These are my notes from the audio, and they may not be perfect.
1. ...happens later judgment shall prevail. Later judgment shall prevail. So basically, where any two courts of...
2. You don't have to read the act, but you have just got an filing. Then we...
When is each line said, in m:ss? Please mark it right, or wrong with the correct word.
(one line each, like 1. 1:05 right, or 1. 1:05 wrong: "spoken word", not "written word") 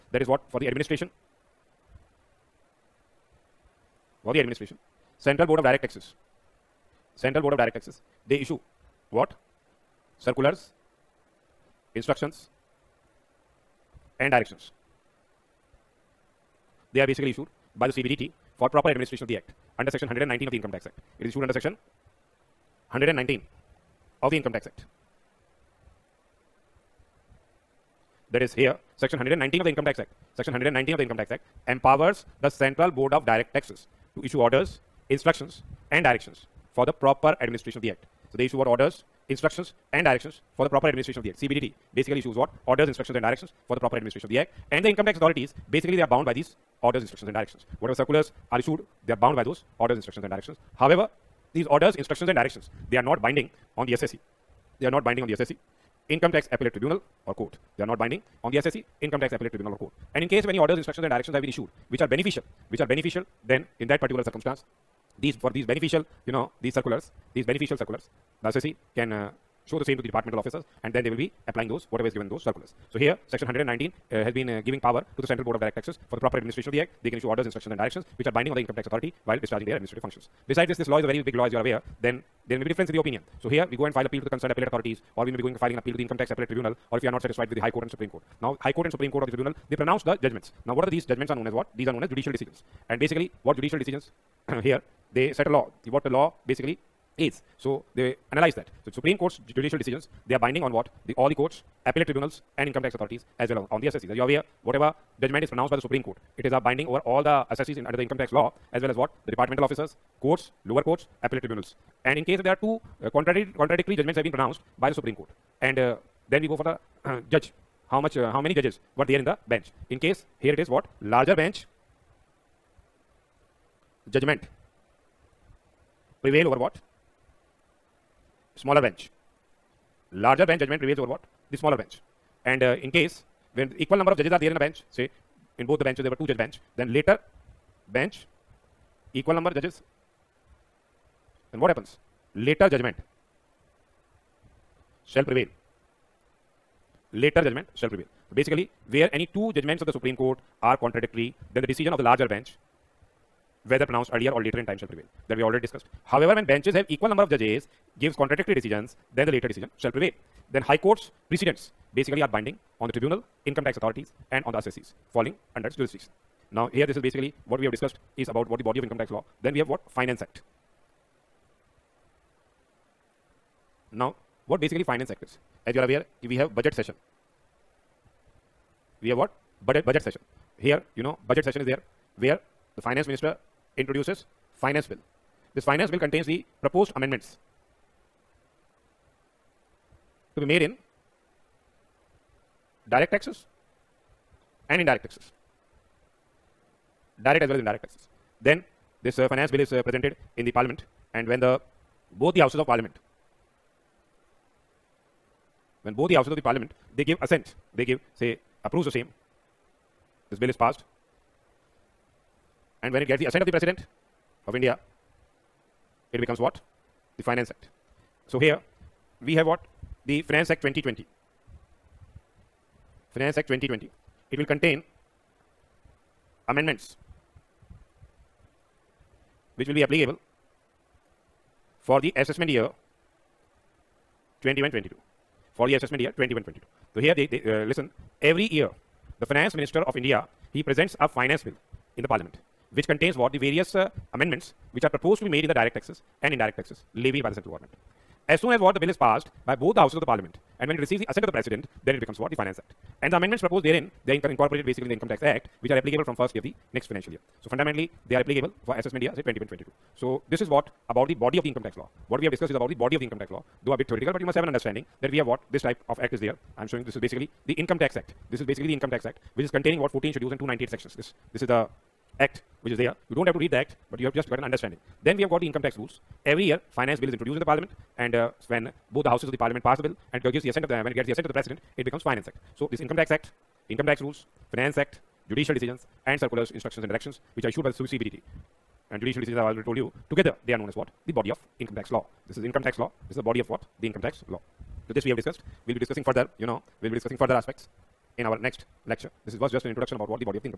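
1. 2:21 wrong: "judgments", not "courts"
2. 4:33 wrong: "understanding", not "filing".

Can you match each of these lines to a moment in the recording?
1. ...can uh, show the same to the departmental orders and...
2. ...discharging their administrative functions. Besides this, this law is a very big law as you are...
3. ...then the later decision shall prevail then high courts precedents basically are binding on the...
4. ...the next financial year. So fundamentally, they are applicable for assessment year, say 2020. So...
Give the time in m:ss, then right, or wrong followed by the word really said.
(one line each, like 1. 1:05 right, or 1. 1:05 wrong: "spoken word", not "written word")
1. 1:08 wrong: "officers", not "orders"
2. 1:19 right
3. 2:39 right
4. 4:16 wrong: "2022", not "2020".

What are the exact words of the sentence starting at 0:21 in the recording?
It is issued under section 119 of the Income Tax Act.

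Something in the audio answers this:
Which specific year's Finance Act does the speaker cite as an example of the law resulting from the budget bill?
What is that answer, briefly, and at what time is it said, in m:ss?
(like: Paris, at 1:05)
2020, at 3:40.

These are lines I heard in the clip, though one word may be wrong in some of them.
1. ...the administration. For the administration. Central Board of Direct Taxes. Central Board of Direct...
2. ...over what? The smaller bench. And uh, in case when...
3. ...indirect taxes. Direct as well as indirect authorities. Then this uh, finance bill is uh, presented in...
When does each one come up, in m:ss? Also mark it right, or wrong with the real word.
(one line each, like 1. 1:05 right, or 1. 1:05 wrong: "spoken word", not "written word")
1. 0:00 right
2. 2:10 right
3. 3:14 wrong: "taxes", not "authorities".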